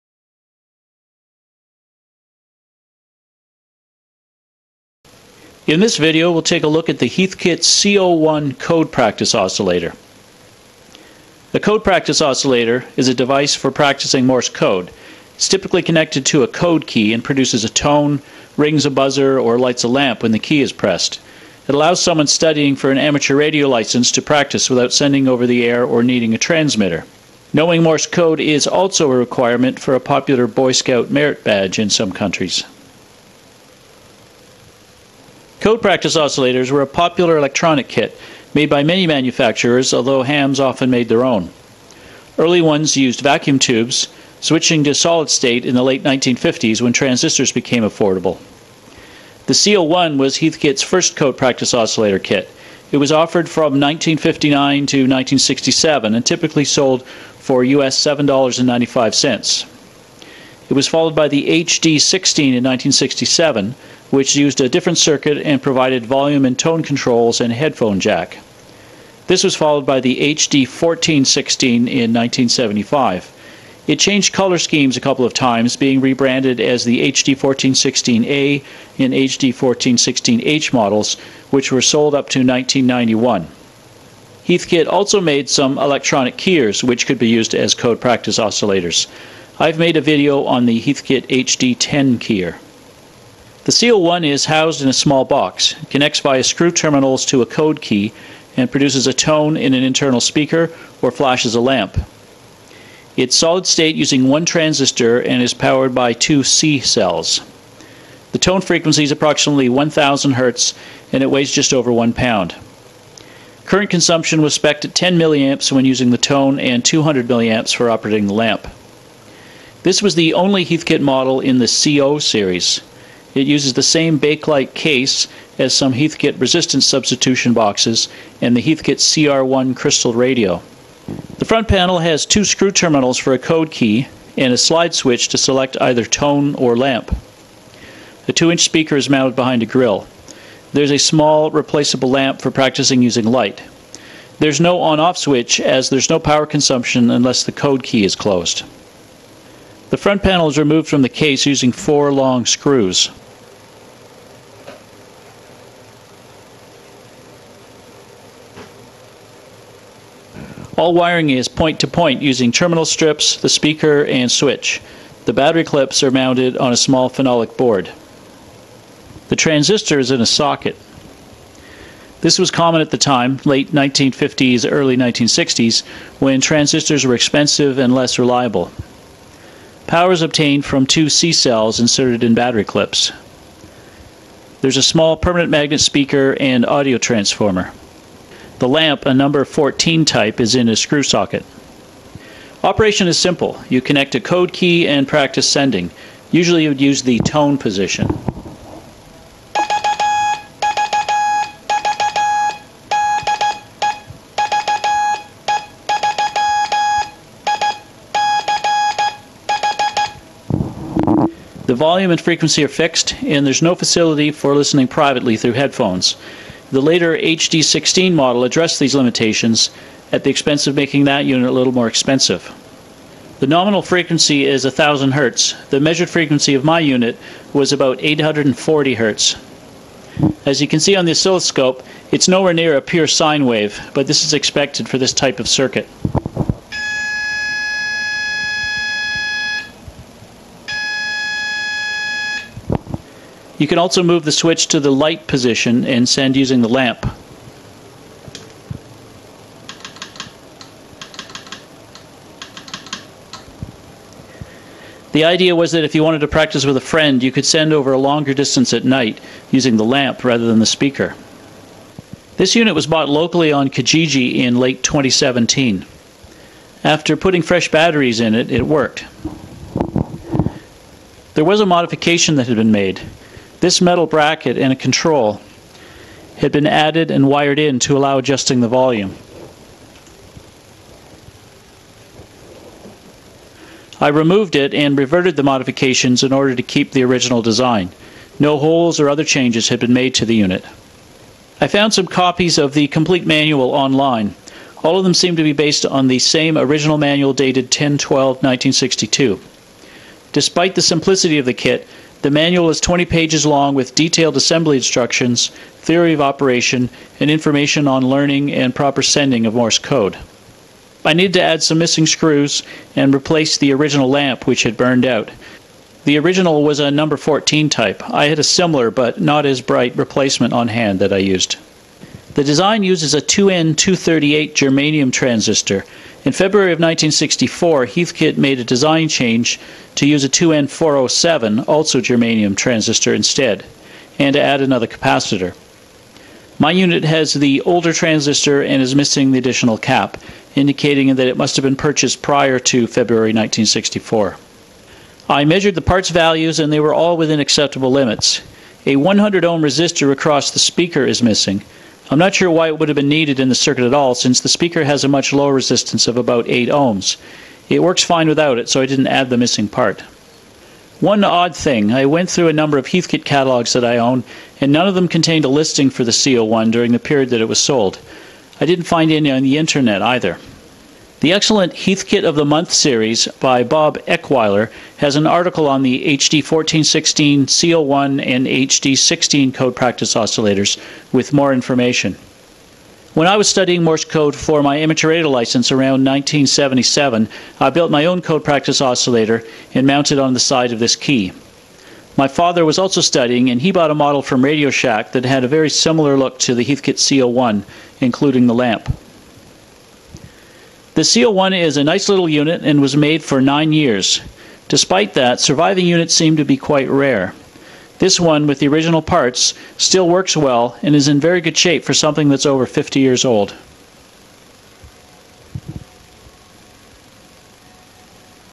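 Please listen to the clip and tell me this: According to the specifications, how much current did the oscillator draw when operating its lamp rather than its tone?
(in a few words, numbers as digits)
200 milliamps.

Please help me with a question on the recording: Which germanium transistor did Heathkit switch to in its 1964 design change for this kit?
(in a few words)
2N407.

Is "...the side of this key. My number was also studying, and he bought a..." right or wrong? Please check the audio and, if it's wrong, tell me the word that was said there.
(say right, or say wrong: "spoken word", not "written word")
wrong: "father", not "number".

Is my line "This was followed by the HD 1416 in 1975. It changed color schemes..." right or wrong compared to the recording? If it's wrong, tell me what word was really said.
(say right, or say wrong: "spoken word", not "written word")
right.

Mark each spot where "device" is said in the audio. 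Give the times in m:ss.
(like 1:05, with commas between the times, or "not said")
0:13.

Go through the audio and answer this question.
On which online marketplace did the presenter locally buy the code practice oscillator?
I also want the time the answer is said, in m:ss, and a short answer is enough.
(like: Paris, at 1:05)
Kijiji, at 4:23.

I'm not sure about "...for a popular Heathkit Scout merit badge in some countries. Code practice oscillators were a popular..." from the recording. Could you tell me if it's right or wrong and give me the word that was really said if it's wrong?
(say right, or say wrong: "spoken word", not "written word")
wrong: "Boy", not "Heathkit".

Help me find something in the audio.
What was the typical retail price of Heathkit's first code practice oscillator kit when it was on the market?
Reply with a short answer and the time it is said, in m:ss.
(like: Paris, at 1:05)
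$7.95, at 0:57.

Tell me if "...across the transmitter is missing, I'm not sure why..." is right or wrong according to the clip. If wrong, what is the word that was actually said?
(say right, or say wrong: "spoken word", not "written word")
wrong: "speaker", not "transmitter".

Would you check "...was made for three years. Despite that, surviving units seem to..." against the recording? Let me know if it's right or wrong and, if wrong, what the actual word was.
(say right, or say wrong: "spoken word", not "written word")
wrong: "nine", not "three".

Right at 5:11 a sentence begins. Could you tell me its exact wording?
I needed to add some missing screws and replace the original lamp which had burned out.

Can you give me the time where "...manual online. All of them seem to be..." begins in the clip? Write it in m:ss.
4:53.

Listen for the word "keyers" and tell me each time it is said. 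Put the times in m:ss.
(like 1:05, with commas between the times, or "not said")
1:26, 1:32.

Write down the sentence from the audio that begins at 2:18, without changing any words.
The 2-inch speaker is mounted behind a grill.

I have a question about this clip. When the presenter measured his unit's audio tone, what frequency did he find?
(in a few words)
840 Hz.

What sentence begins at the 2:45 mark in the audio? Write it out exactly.
The battery clips are mounted on a small phenolic board.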